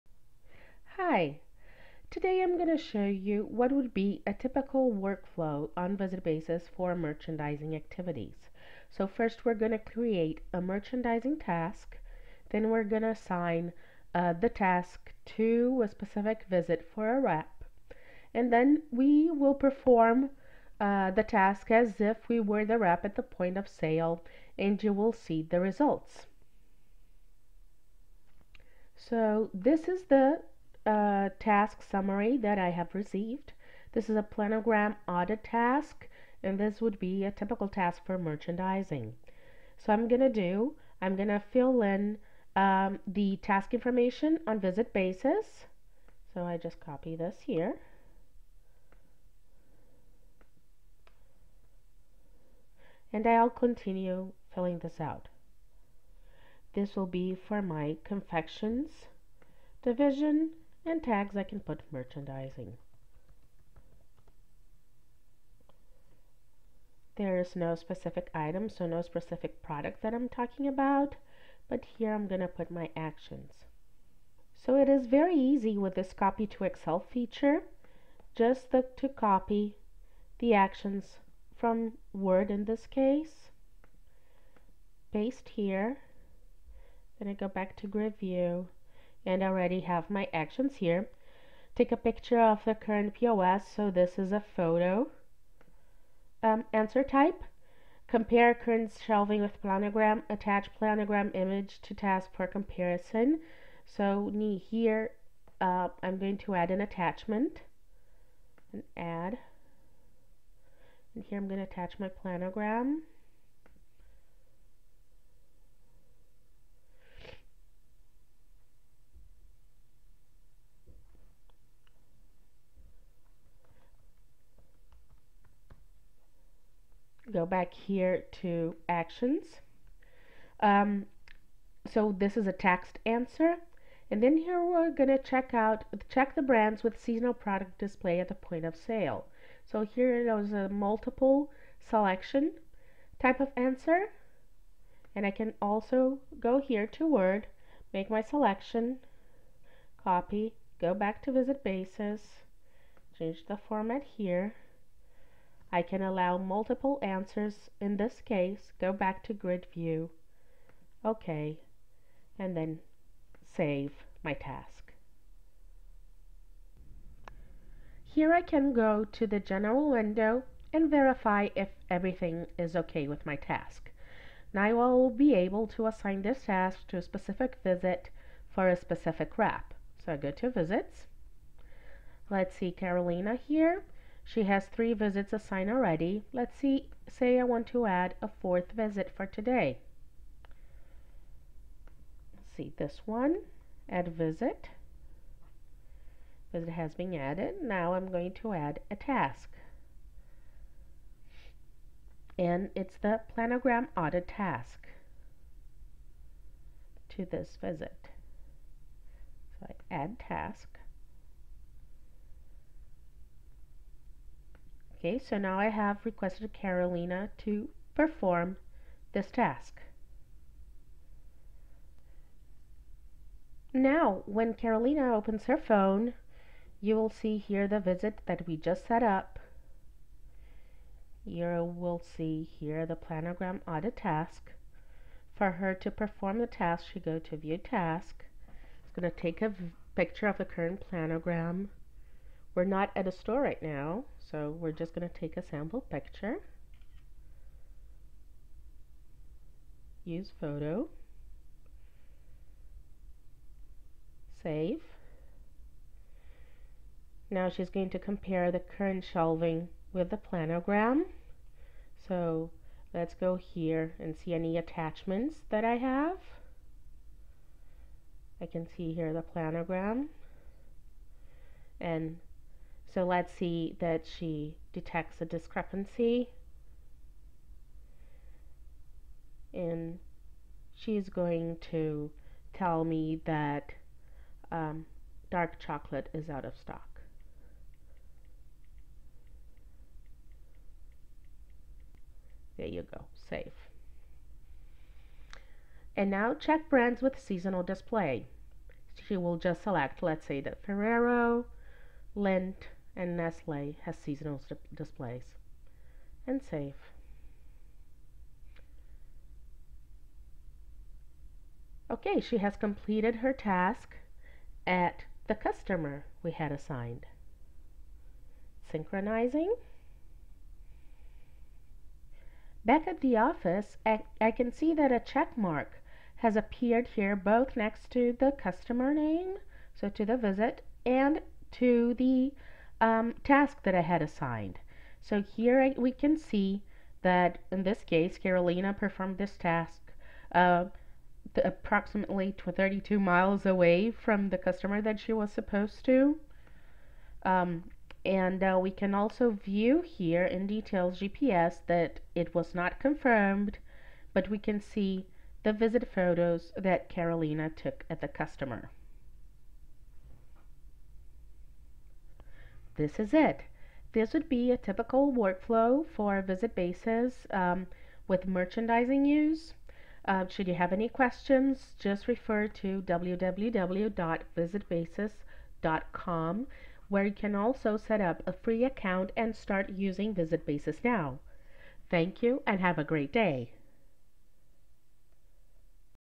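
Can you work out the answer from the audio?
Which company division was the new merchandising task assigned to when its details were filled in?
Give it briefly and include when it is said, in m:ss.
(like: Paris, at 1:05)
Confections division, at 0:58.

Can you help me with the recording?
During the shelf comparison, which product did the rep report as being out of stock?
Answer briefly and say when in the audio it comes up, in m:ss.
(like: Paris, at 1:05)
Dark chocolate, at 4:45.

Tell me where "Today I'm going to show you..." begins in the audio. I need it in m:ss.
0:02.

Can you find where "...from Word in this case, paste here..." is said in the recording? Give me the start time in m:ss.
1:21.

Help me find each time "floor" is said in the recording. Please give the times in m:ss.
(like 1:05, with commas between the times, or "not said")
not said.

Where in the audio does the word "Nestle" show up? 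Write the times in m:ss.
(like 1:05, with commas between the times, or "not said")
5:03.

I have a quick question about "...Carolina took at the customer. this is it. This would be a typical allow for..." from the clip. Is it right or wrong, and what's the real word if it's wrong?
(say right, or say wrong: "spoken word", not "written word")
wrong: "workflow", not "allow".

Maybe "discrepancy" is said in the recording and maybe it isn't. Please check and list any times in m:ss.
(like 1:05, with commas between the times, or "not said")
4:35.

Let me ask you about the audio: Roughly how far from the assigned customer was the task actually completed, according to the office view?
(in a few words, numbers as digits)
32 miles.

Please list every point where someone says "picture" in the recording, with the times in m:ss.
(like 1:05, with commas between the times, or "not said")
1:31, 3:59, 4:05.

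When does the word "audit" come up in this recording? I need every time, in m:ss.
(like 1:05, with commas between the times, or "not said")
0:35, 3:23, 3:53.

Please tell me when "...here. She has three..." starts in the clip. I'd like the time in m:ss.
3:03.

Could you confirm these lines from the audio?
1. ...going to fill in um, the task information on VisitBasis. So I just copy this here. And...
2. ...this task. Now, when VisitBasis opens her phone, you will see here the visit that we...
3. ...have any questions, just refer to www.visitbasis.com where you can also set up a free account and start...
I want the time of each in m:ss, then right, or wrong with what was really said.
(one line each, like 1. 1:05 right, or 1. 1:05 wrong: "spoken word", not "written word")
1. 0:41 right
2. 3:39 wrong: "Carolina", not "VisitBasis"
3. 6:10 right.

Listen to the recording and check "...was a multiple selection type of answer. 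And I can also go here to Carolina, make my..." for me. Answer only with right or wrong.
wrong.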